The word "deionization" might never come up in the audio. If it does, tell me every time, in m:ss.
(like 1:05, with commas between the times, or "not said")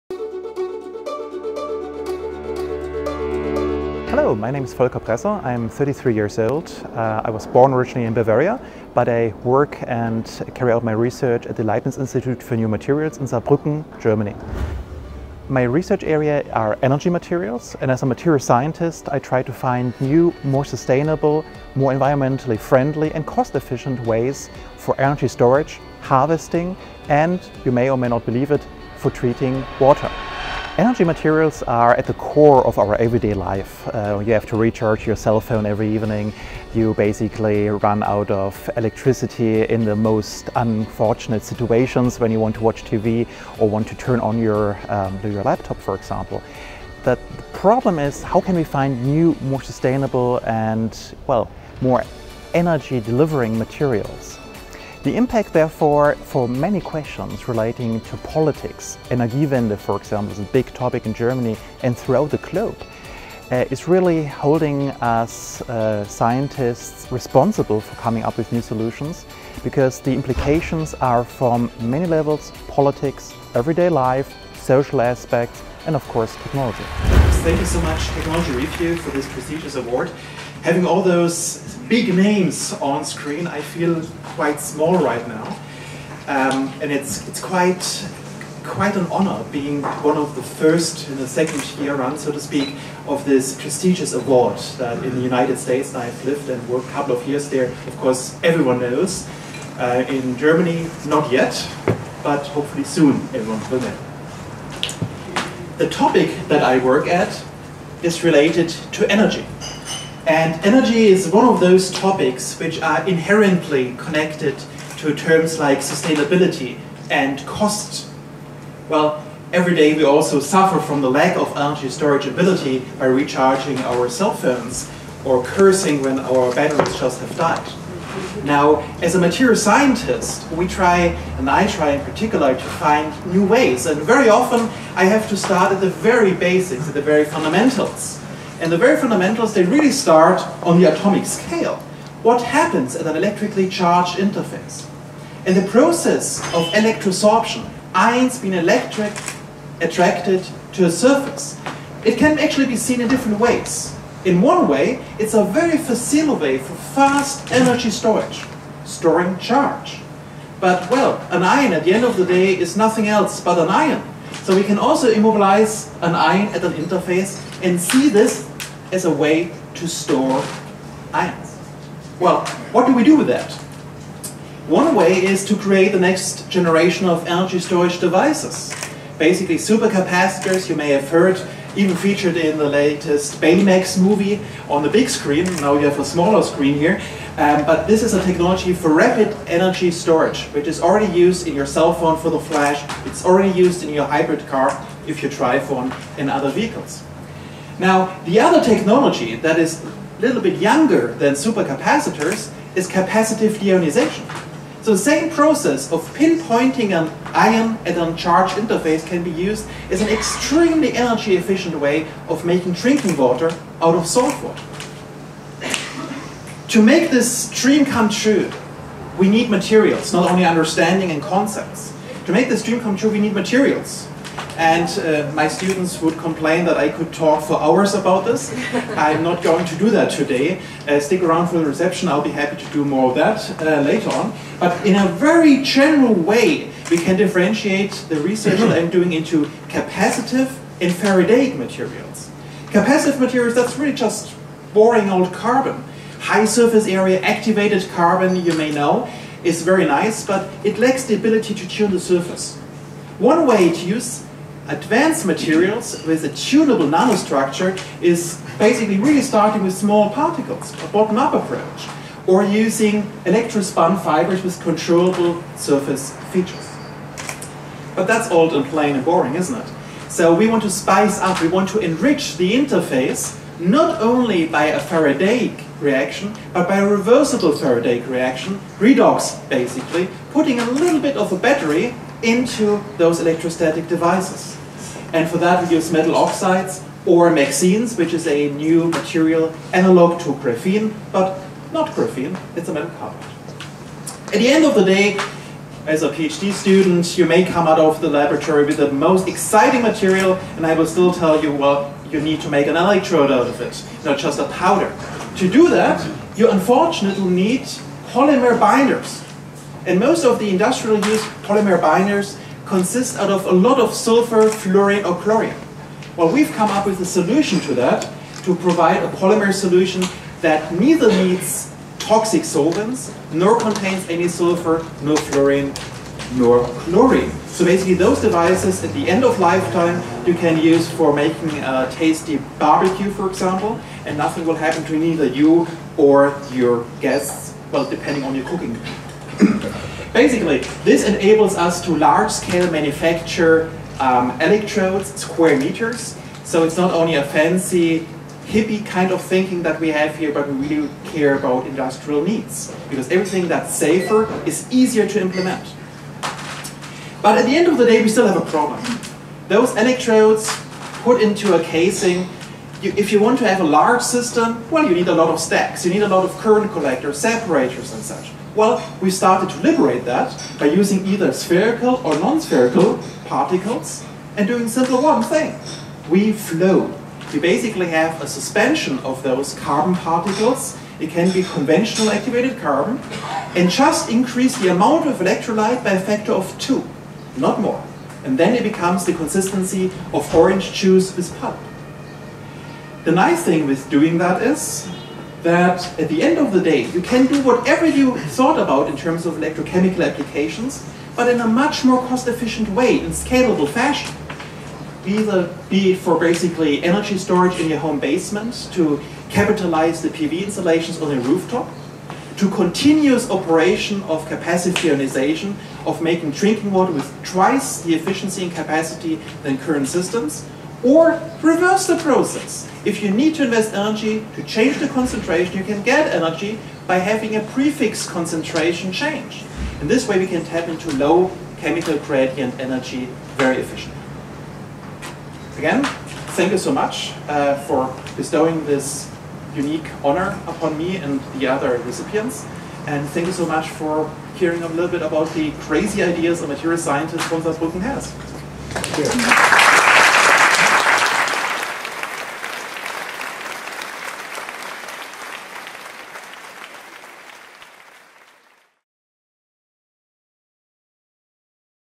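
3:23, 6:54.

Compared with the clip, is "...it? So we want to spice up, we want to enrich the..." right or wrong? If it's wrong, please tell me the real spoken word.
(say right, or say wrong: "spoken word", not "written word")
right.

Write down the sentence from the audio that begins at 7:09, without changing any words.
And this way we can tap into low chemical gradient energy very efficiently.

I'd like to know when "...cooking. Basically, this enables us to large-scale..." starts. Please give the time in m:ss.
5:38.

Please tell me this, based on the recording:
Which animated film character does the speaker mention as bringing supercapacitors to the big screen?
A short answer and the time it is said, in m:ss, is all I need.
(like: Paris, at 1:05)
Baymax, at 3:03.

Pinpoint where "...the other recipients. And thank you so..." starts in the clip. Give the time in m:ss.
7:21.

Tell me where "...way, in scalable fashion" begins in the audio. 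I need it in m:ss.
6:42.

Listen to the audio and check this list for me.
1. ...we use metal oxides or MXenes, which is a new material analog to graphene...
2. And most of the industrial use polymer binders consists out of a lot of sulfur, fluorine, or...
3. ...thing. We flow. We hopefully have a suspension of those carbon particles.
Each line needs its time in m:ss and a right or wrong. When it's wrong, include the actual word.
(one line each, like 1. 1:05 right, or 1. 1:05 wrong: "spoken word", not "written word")
1. 4:45 right
2. 5:09 right
3. 6:15 wrong: "basically", not "hopefully".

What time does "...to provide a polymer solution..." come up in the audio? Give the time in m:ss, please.
5:18.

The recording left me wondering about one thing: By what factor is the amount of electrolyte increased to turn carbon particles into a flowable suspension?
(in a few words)
2.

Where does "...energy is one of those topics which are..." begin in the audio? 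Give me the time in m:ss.
1:50.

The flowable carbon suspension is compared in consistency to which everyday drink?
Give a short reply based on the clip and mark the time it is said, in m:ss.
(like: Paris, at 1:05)
orange juice with pulp, at 6:30.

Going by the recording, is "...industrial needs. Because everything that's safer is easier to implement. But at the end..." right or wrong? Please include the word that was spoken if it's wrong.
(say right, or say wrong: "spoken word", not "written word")
right.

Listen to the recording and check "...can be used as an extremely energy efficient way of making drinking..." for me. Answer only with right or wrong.
right.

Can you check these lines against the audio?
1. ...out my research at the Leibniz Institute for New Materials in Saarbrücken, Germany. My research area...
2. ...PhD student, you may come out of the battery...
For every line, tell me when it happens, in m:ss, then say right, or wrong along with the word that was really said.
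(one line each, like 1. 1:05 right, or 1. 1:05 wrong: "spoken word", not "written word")
1. 0:10 right
2. 4:56 wrong: "laboratory", not "battery".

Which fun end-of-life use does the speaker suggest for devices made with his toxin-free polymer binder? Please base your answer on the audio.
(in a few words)
a tasty barbecue.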